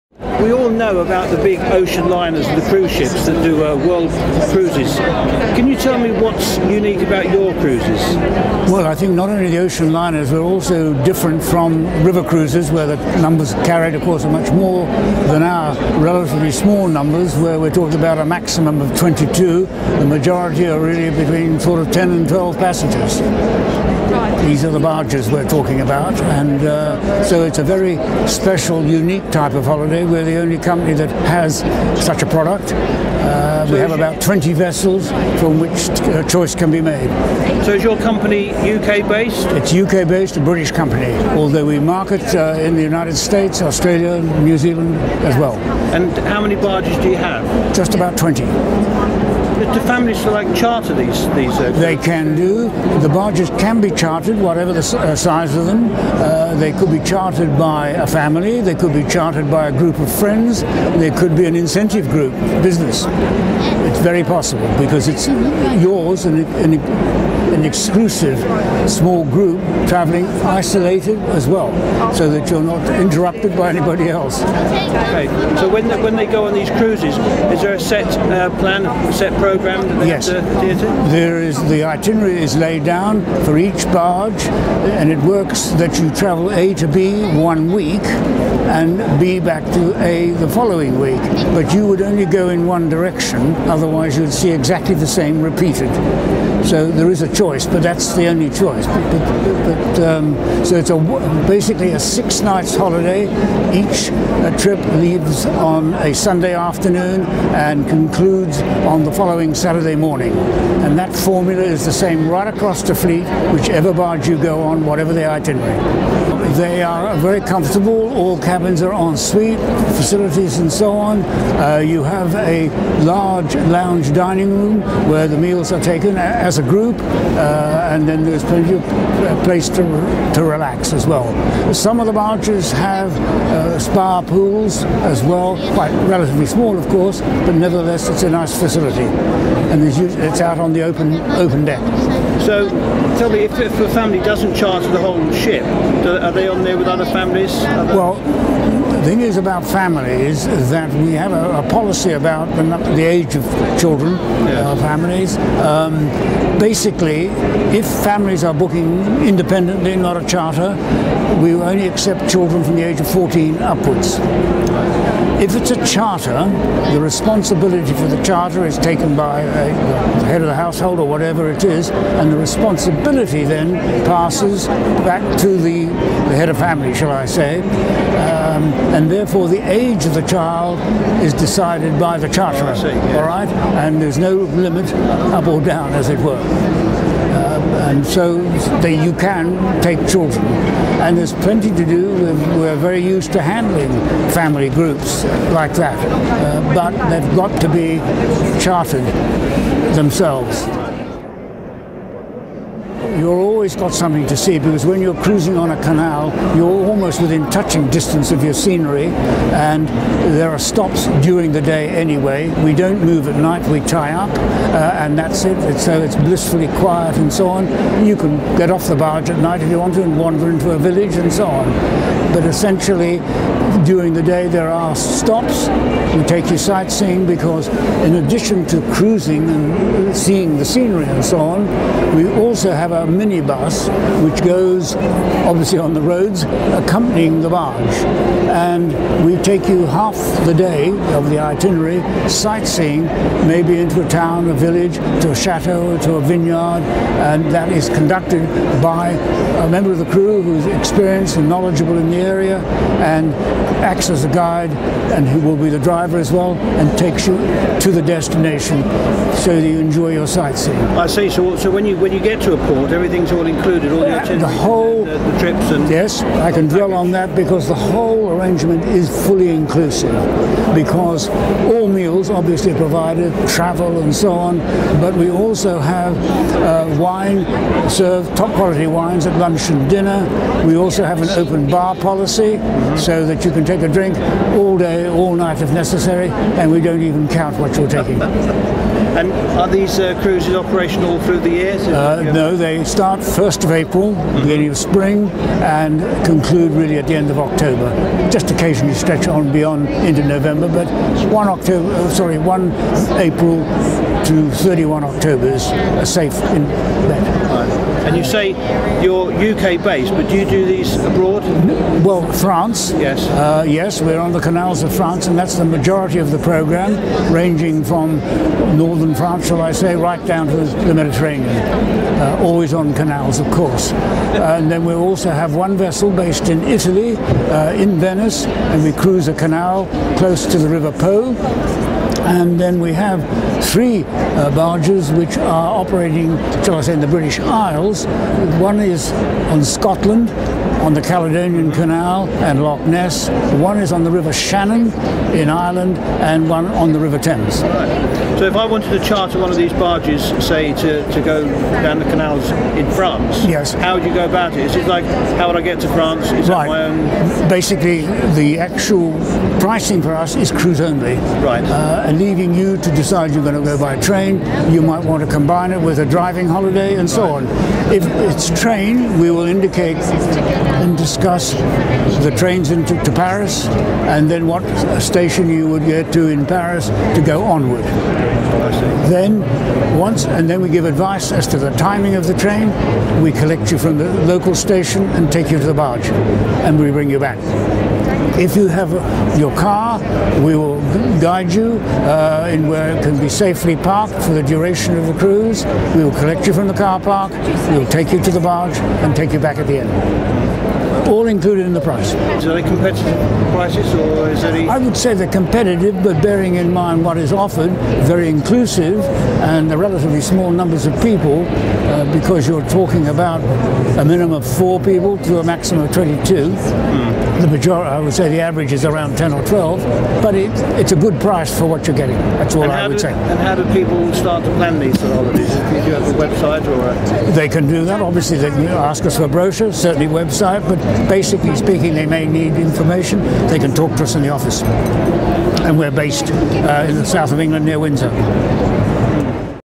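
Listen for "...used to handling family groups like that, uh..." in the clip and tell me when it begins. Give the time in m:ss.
3:13.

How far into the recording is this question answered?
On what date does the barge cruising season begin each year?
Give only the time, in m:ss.
4:53.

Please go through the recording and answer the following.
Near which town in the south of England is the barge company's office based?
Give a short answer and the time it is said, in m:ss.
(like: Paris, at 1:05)
Windsor, at 7:17.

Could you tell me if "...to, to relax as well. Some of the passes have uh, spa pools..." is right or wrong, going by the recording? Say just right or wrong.
wrong.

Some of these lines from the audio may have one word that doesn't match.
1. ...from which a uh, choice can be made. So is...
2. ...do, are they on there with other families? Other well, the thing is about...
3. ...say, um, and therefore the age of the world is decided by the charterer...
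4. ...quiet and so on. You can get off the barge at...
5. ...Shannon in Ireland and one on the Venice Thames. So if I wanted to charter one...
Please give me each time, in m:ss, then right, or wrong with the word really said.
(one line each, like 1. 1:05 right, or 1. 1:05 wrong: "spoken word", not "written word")
1. 0:35 right
2. 2:26 right
3. 2:57 wrong: "child", not "world"
4. 3:36 right
5. 5:44 wrong: "River", not "Venice".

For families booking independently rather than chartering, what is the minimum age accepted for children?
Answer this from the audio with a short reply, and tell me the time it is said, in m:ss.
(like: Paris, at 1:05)
14, at 2:43.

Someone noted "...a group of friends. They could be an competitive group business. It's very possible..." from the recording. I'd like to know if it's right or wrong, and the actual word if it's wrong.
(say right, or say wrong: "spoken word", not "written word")
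wrong: "incentive", not "competitive".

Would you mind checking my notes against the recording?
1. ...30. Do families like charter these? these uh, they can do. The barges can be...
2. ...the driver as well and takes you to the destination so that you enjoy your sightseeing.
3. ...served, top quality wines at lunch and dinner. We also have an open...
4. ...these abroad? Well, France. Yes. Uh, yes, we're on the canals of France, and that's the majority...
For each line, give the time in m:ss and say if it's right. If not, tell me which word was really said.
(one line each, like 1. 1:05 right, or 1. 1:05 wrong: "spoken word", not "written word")
1. 0:48 wrong: "20", not "30"
2. 4:15 right
3. 4:37 right
4. 5:10 right.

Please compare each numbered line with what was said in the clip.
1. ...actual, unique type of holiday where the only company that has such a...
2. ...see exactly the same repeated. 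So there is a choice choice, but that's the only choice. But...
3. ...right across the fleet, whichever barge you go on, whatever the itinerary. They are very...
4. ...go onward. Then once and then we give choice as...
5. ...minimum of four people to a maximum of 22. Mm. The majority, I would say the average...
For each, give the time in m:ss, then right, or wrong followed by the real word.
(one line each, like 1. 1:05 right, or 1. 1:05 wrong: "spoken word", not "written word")
1. 0:28 wrong: "special", not "actual"
2. 1:34 right
3. 1:52 right
4. 6:17 wrong: "advice", not "choice"
5. 6:54 right.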